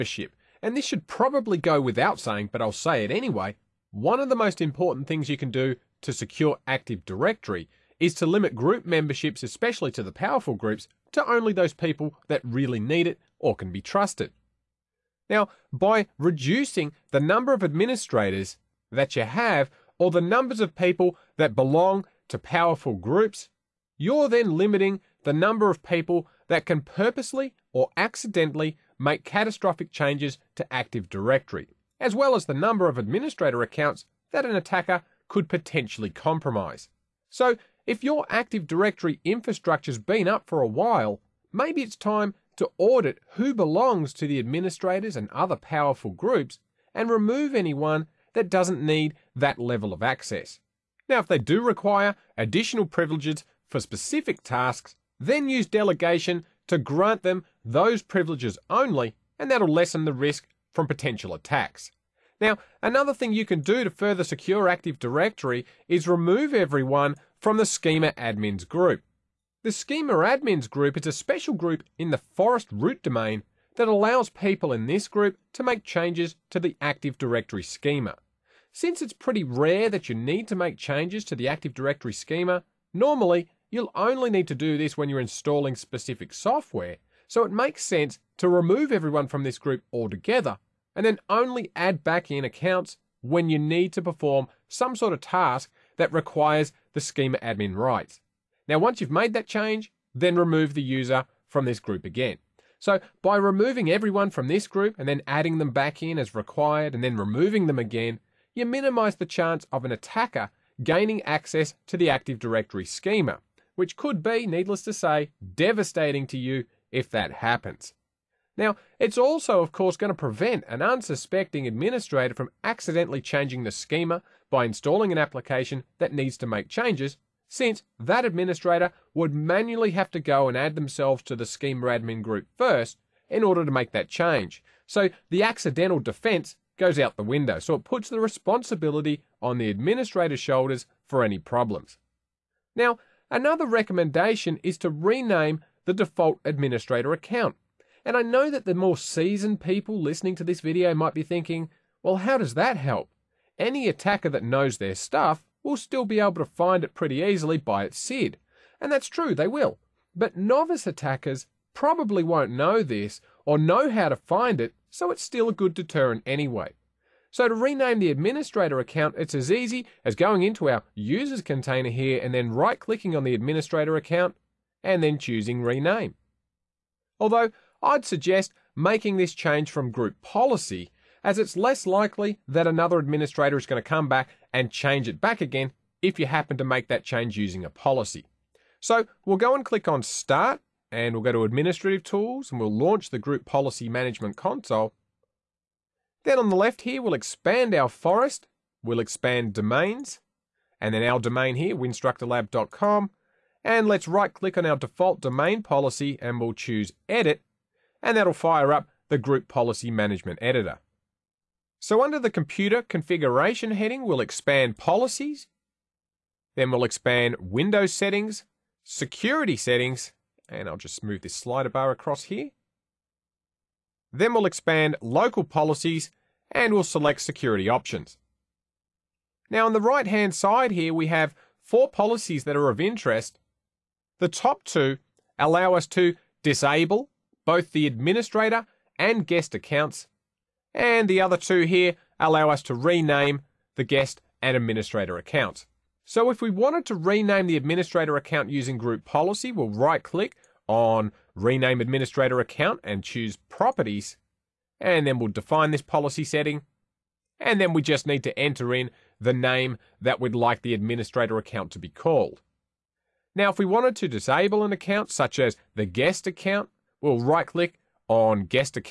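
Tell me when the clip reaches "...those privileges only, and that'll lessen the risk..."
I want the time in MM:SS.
00:57.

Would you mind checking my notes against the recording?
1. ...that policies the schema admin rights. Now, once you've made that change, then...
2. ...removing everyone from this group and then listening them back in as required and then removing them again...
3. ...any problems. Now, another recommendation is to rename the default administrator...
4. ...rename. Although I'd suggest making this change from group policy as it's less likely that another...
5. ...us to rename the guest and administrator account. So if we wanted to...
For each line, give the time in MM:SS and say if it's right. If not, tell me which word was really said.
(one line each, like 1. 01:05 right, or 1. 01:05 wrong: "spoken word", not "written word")
1. 01:35 wrong: "requires", not "policies"
2. 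01:43 wrong: "adding", not "listening"
3. 02:21 right
4. 02:55 right
5. 04:02 right.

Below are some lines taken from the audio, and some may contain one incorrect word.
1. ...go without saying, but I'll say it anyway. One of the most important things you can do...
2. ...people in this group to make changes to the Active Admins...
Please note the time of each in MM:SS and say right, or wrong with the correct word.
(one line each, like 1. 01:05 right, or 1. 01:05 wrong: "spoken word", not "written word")
1. 00:01 right
2. 01:14 wrong: "Directory", not "Admins".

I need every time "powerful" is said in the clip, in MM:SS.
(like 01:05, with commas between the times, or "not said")
00:10, 00:22, 00:45.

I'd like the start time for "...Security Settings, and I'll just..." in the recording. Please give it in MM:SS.
03:38.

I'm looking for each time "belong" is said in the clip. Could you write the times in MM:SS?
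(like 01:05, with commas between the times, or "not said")
00:21, 00:43.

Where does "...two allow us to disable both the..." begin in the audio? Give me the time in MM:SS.
03:54.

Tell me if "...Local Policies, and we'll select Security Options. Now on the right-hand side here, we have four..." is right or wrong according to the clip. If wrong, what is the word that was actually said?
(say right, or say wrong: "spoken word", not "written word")
right.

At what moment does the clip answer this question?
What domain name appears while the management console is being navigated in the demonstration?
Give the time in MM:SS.
03:21.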